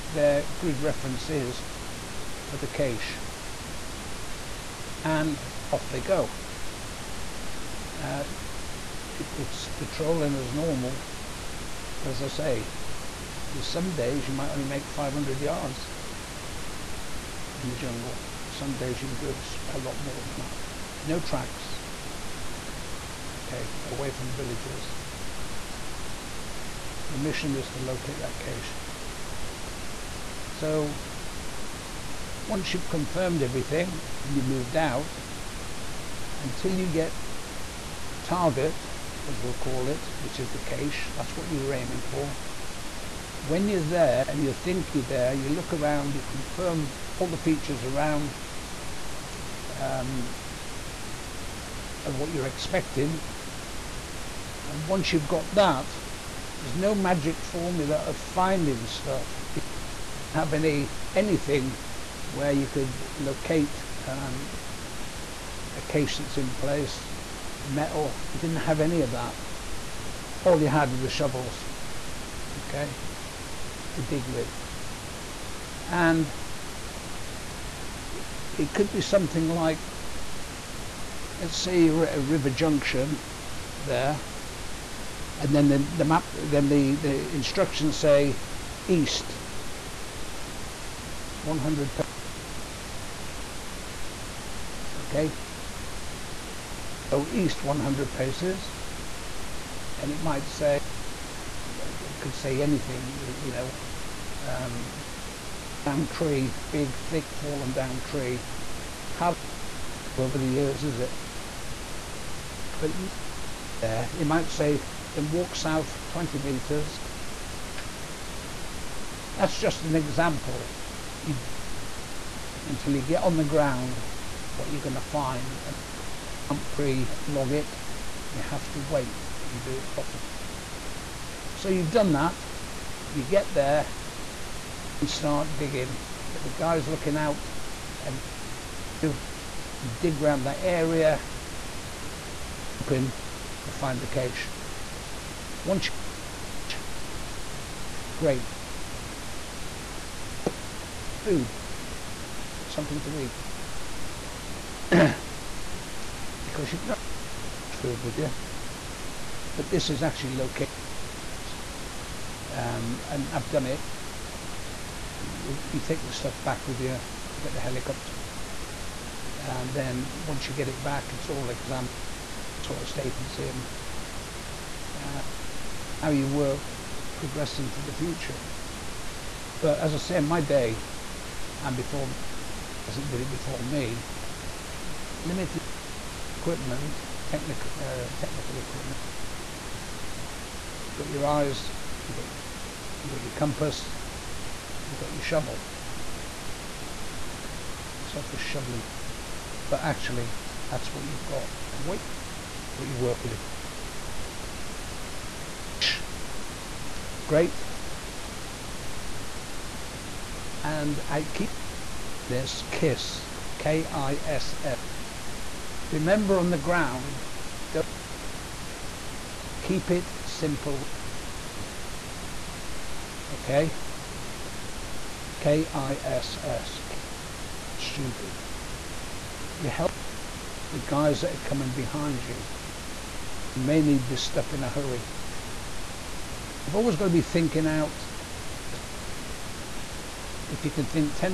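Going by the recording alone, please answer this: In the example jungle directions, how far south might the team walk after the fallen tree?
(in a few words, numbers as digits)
20 metres.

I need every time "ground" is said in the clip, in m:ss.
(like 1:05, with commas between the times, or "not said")
2:03, 3:36.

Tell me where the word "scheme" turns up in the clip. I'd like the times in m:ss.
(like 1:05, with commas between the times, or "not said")
not said.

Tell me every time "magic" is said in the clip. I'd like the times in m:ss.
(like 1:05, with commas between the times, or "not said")
0:56.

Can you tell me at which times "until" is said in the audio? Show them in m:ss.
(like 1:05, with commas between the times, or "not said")
0:36, 2:02.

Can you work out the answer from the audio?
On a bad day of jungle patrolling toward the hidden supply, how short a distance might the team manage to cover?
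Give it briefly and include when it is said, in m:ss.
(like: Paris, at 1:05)
500 yards, at 0:14.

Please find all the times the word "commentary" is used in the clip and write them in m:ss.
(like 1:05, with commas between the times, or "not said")
not said.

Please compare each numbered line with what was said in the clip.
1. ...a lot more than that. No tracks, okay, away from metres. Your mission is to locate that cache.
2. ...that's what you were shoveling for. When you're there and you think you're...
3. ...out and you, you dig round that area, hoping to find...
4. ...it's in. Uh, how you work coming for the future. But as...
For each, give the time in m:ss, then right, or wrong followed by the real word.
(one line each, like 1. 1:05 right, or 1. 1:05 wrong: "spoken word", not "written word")
1. 0:19 wrong: "villages", not "metres"
2. 0:41 wrong: "aiming", not "shoveling"
3. 2:17 right
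4. 2:53 wrong: "progressing", not "coming".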